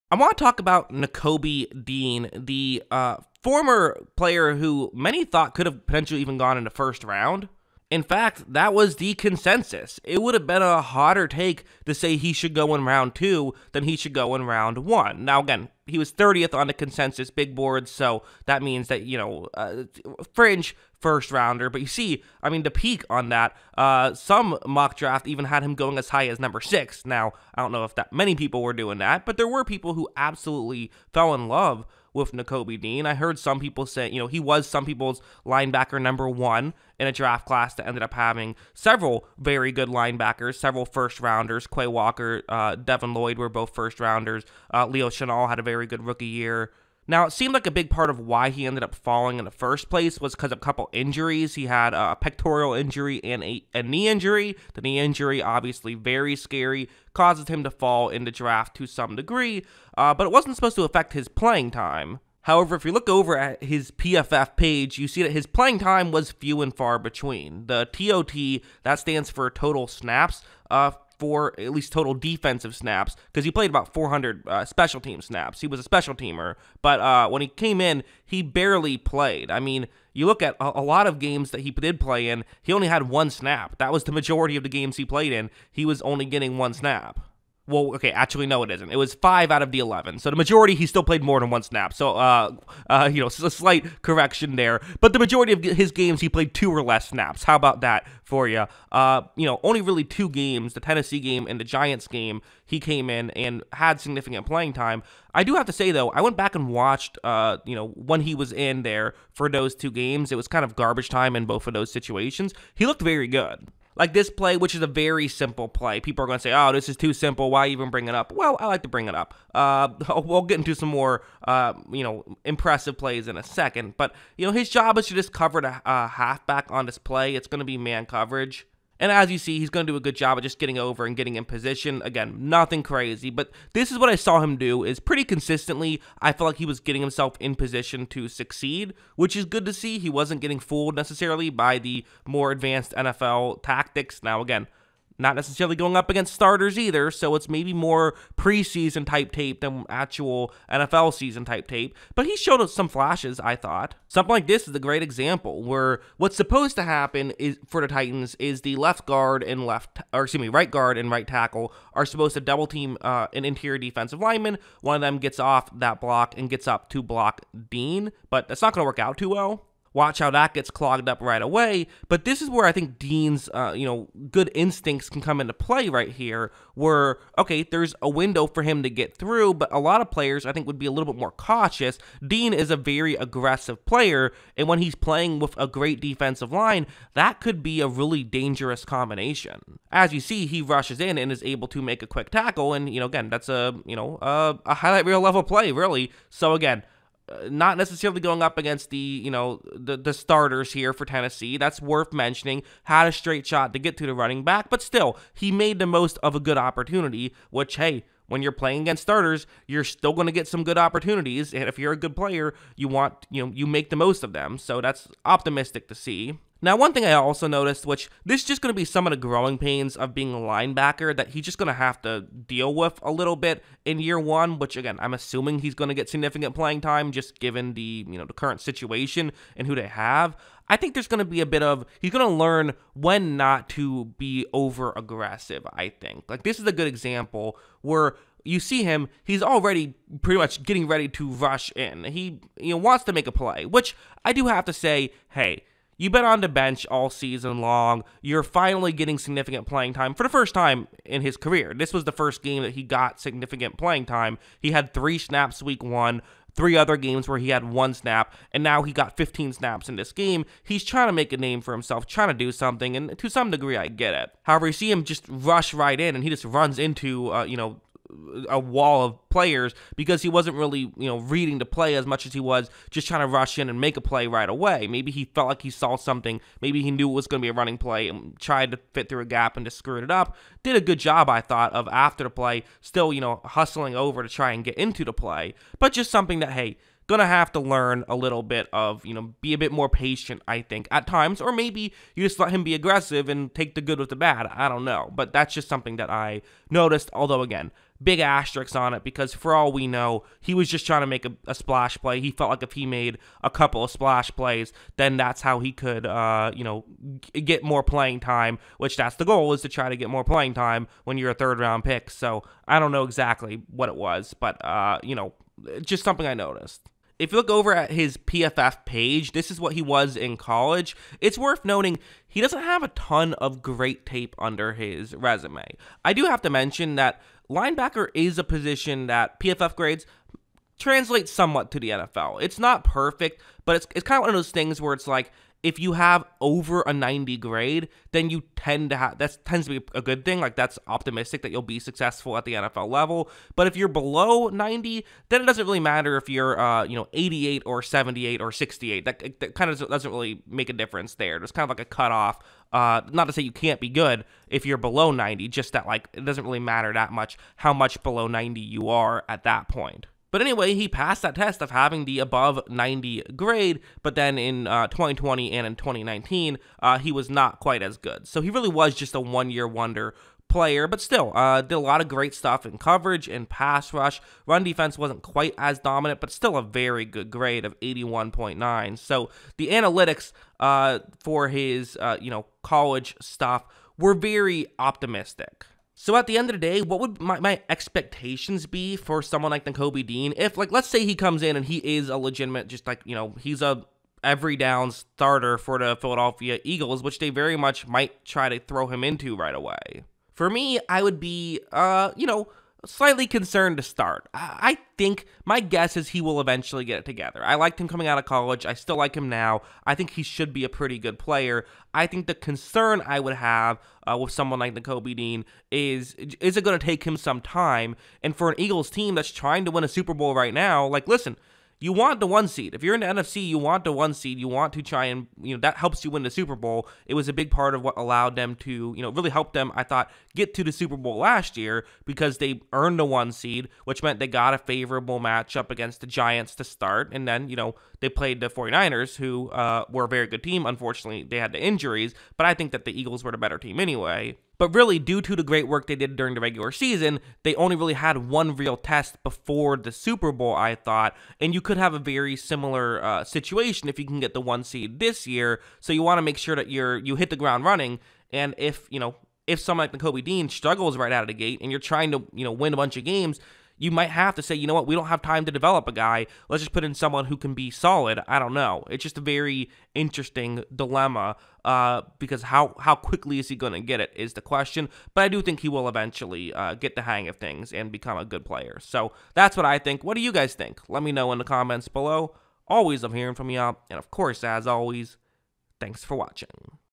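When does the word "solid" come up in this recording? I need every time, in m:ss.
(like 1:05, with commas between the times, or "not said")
7:47.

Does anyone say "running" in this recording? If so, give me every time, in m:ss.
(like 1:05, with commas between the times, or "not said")
3:24, 4:37, 7:37.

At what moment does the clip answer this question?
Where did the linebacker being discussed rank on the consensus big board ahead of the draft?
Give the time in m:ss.
0:16.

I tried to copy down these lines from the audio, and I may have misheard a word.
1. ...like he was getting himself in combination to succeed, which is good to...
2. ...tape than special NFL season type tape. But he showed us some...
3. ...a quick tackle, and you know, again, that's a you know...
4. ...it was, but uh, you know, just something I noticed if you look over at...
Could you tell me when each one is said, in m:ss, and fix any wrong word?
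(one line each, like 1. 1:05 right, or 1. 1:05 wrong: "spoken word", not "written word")
1. 2:16 wrong: "position", not "combination"
2. 2:29 wrong: "actual", not "special"
3. 3:12 right
4. 5:13 right.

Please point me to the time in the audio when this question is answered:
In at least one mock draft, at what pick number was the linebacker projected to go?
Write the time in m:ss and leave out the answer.
0:26.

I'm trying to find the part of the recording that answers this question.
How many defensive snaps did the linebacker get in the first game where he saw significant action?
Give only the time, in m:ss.
4:19.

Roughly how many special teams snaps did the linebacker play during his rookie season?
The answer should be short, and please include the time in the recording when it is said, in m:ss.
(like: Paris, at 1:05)
About 400, at 1:13.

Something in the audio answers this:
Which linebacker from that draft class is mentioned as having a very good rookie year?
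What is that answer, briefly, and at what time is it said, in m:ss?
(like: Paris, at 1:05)
Leo Chenal, at 0:44.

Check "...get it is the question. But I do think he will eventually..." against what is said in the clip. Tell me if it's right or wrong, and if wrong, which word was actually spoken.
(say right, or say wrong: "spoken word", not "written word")
right.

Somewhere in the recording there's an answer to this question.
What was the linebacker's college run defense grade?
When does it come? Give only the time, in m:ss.
6:17.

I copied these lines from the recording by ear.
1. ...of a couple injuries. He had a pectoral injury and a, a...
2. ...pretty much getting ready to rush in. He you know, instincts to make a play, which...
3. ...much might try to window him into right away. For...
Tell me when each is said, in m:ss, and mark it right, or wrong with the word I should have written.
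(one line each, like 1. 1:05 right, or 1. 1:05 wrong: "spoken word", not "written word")
1. 0:50 right
2. 4:00 wrong: "wants", not "instincts"
3. 6:37 wrong: "throw", not "window".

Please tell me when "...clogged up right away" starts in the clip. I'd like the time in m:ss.
2:50.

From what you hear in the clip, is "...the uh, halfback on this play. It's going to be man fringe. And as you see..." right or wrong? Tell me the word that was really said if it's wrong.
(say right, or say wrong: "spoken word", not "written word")
wrong: "coverage", not "fringe".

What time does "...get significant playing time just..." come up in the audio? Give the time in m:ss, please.
3:45.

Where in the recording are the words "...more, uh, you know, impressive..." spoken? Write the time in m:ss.
2:00.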